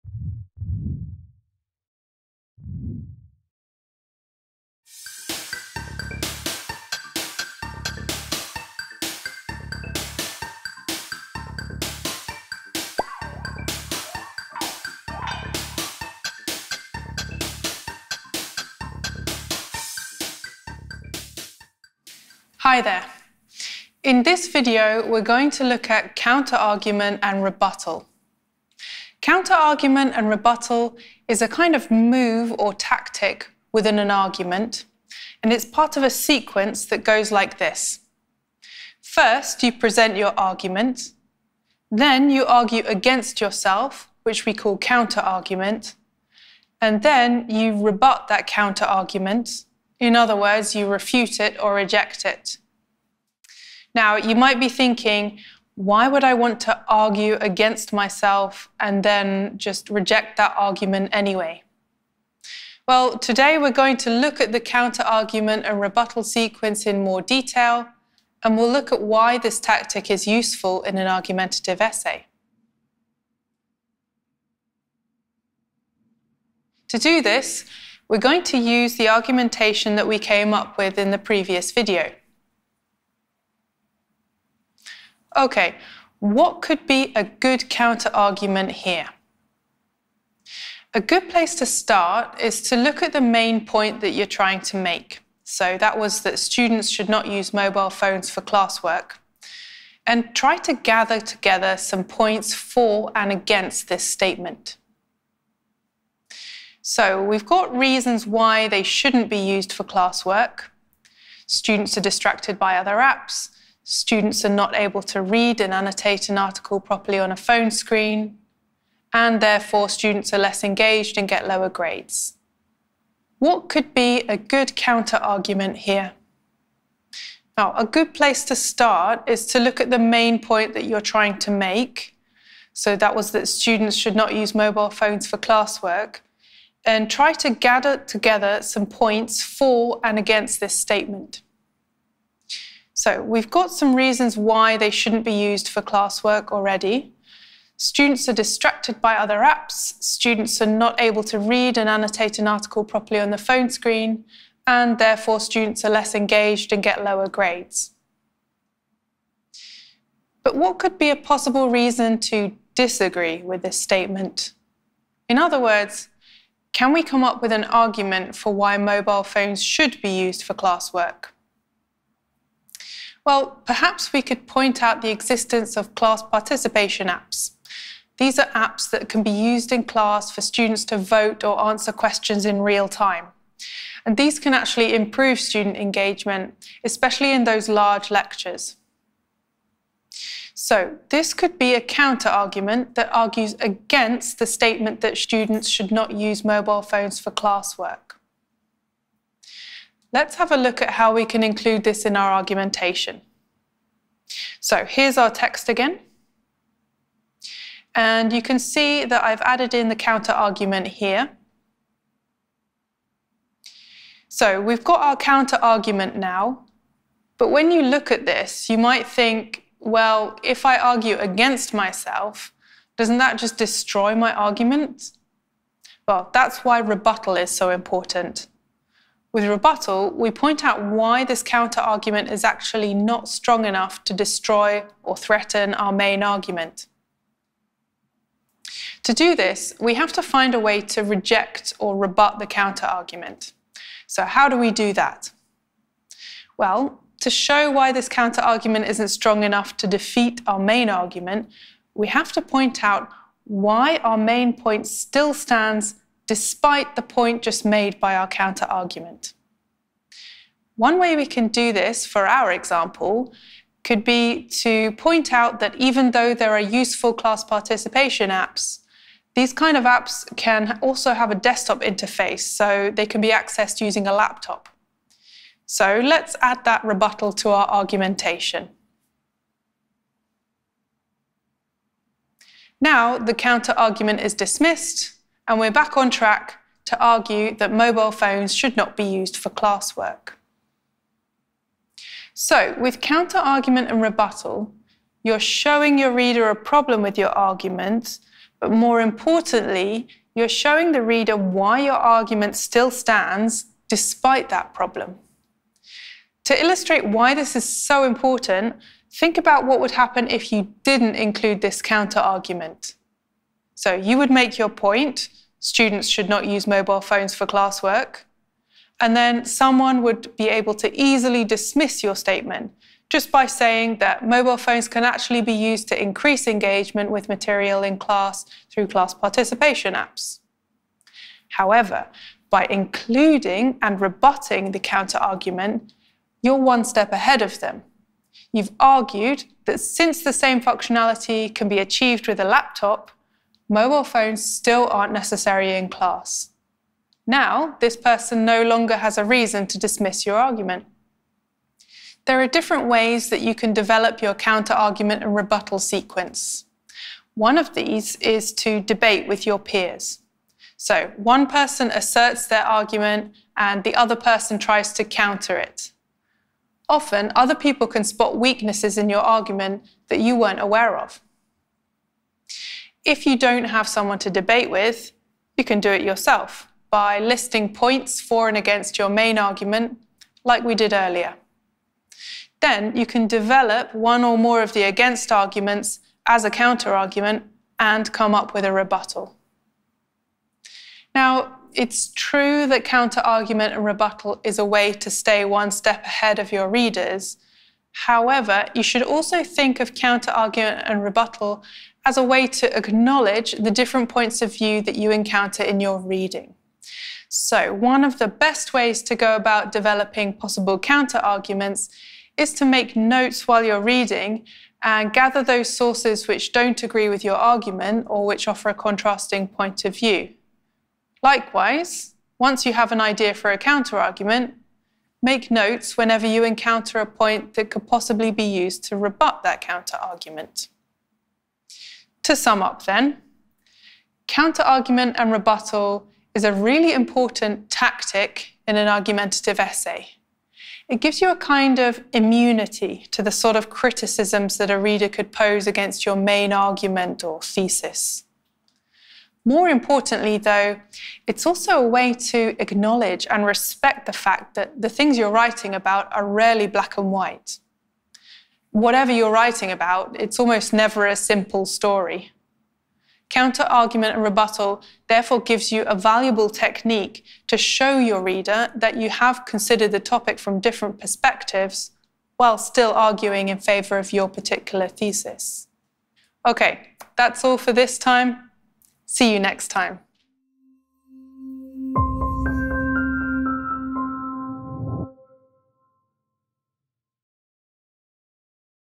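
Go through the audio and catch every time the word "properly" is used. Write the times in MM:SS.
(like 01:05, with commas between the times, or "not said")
01:56, 02:32.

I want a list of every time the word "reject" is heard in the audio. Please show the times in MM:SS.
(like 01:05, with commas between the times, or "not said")
00:51, 00:59, 04:01.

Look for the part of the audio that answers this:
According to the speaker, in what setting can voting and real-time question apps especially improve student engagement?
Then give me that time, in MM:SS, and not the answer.
03:07.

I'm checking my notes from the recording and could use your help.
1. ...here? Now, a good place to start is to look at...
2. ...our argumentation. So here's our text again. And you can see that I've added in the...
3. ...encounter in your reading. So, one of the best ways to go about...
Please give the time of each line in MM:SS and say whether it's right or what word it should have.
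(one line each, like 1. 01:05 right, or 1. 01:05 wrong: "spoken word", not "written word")
1. 02:05 right
2. 03:22 right
3. 06:45 right.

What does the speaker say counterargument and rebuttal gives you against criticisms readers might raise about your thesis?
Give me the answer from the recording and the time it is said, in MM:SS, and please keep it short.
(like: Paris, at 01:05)
immunity, at 07:22.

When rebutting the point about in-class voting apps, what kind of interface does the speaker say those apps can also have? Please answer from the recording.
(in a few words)
desktop interface.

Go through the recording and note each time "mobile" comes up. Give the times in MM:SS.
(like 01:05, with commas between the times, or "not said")
01:37, 02:14, 02:48, 03:16, 04:47, 05:16, 05:24, 05:43.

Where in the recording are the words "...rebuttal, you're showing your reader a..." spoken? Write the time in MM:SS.
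04:54.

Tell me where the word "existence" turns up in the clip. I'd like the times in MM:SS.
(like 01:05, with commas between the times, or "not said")
02:55.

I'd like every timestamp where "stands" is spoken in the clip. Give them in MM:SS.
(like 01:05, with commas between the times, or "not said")
04:15, 05:02.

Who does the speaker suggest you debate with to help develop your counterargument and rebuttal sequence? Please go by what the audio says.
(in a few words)
peers.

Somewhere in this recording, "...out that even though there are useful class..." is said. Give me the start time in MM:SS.
04:25.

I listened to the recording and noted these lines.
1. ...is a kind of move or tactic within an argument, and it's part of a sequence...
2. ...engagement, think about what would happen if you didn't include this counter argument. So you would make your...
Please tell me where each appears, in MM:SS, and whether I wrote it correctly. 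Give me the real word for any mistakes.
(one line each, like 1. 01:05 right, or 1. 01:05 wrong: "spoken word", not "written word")
1. 00:31 right
2. 05:08 wrong: "important", not "engagement".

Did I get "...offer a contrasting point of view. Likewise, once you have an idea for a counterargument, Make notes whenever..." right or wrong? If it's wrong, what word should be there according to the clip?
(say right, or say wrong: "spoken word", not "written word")
right.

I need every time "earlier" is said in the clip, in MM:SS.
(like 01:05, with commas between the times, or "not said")
06:20.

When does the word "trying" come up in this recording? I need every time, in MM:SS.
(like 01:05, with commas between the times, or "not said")
01:34, 02:11.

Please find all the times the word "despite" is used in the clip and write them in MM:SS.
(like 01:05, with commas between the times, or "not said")
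04:16, 05:03.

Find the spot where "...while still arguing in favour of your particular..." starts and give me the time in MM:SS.
07:52.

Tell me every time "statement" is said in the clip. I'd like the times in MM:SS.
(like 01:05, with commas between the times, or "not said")
01:44, 02:20, 02:43, 03:14, 05:22.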